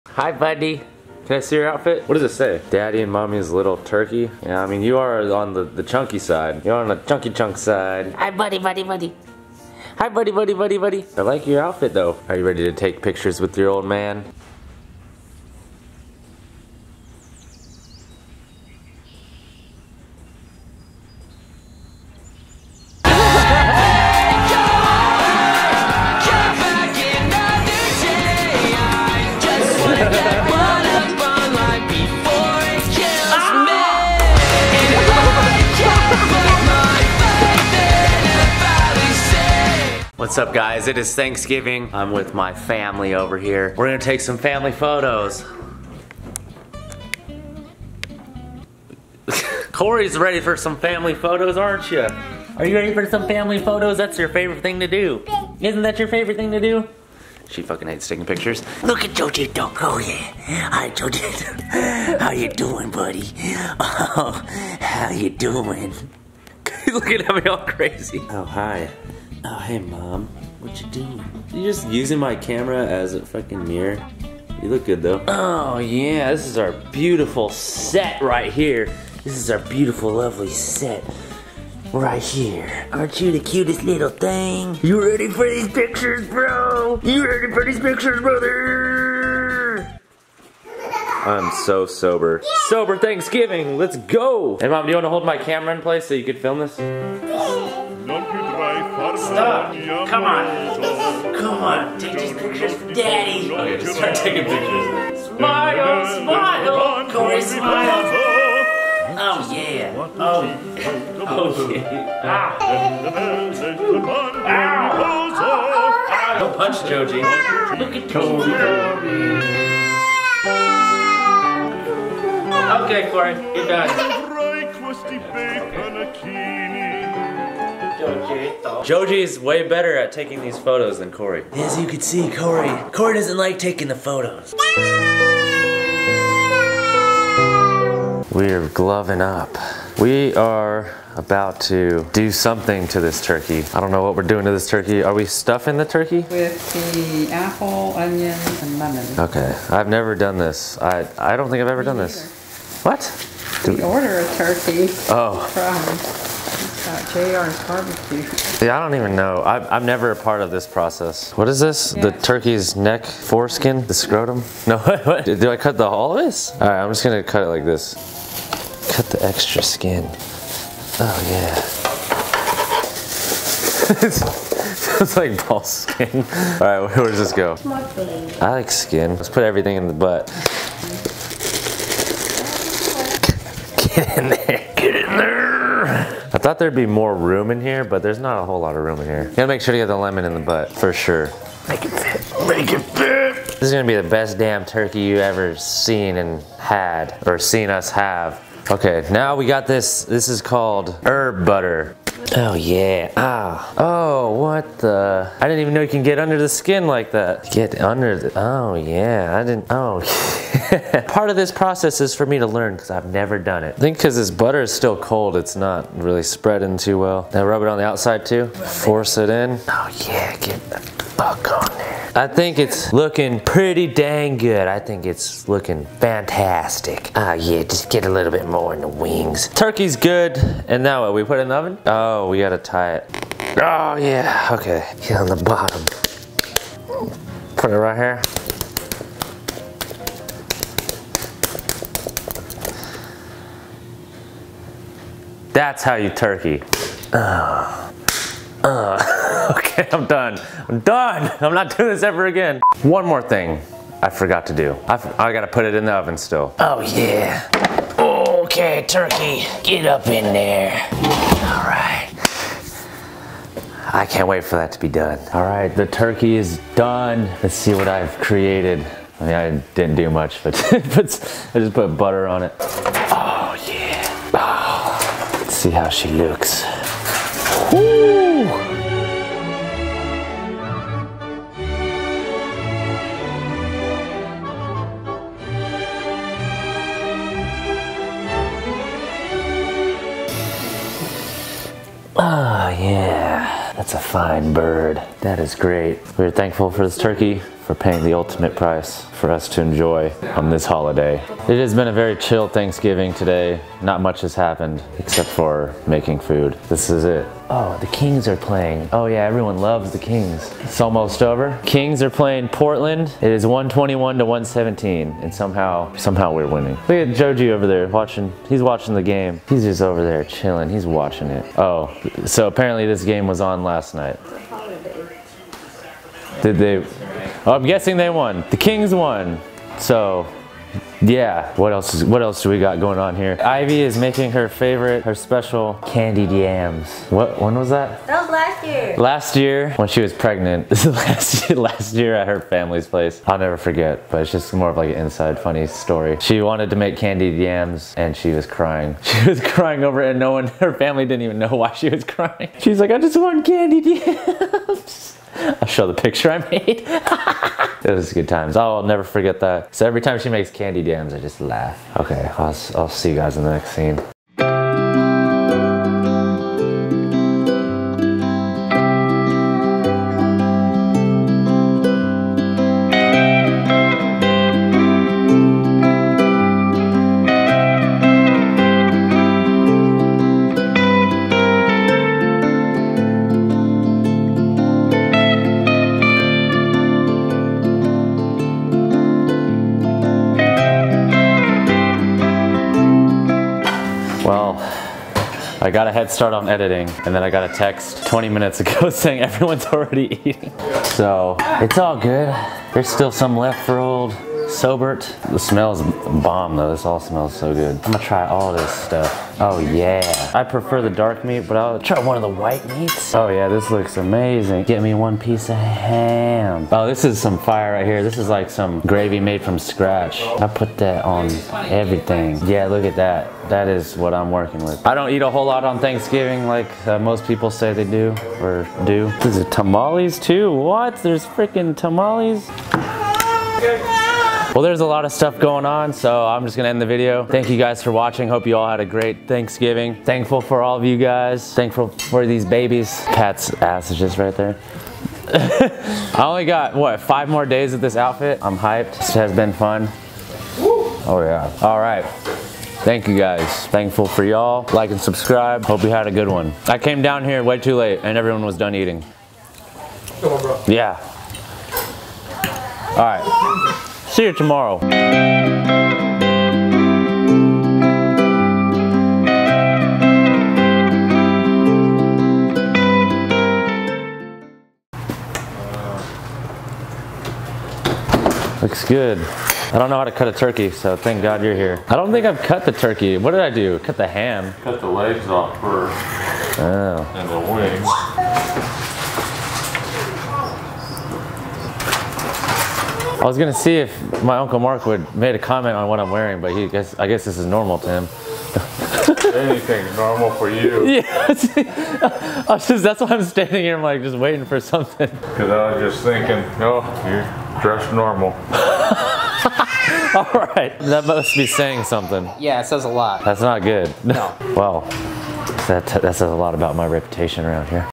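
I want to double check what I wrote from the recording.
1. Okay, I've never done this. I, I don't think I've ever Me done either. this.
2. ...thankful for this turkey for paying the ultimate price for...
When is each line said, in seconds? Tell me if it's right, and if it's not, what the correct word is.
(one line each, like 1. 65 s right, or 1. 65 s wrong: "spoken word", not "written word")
1. 149 s right
2. 296 s right.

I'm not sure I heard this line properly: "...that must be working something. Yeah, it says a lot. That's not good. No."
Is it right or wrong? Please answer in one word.
wrong.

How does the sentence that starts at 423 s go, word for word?
That is what I'm working with.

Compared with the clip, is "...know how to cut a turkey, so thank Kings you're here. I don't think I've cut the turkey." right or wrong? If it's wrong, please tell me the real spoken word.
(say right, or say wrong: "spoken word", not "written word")
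wrong: "God", not "Kings".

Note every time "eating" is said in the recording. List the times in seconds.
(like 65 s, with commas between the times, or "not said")
400 s, 458 s.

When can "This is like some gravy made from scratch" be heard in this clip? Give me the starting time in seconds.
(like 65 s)
418 s.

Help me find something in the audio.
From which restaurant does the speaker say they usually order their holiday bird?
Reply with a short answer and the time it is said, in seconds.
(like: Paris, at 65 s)
JR's barbecue, at 157 s.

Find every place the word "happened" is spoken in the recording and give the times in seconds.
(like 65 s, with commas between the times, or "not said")
304 s.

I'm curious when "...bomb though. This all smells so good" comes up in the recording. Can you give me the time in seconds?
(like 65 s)
406 s.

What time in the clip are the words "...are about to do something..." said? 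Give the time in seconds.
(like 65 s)
140 s.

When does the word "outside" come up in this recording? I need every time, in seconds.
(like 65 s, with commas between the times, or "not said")
217 s.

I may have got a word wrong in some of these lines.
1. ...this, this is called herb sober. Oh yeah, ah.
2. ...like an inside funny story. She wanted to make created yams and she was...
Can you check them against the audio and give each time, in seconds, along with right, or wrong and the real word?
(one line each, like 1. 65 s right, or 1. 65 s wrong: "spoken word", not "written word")
1. 199 s wrong: "butter", not "sober"
2. 344 s wrong: "candied", not "created".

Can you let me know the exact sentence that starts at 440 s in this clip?
Thankful for all of you guys.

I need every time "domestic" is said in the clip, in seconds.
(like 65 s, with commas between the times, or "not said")
not said.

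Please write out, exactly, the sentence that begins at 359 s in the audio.
So every time she makes candy dams, I just laugh.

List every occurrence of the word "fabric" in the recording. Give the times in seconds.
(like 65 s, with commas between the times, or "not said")
not said.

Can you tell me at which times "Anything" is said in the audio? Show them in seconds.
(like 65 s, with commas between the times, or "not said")
499 s.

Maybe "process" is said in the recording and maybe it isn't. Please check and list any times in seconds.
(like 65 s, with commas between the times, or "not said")
160 s, 211 s.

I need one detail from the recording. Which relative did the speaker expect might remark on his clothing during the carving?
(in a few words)
Uncle Mark.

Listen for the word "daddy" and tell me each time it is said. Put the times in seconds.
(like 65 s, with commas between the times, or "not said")
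2 s, 102 s.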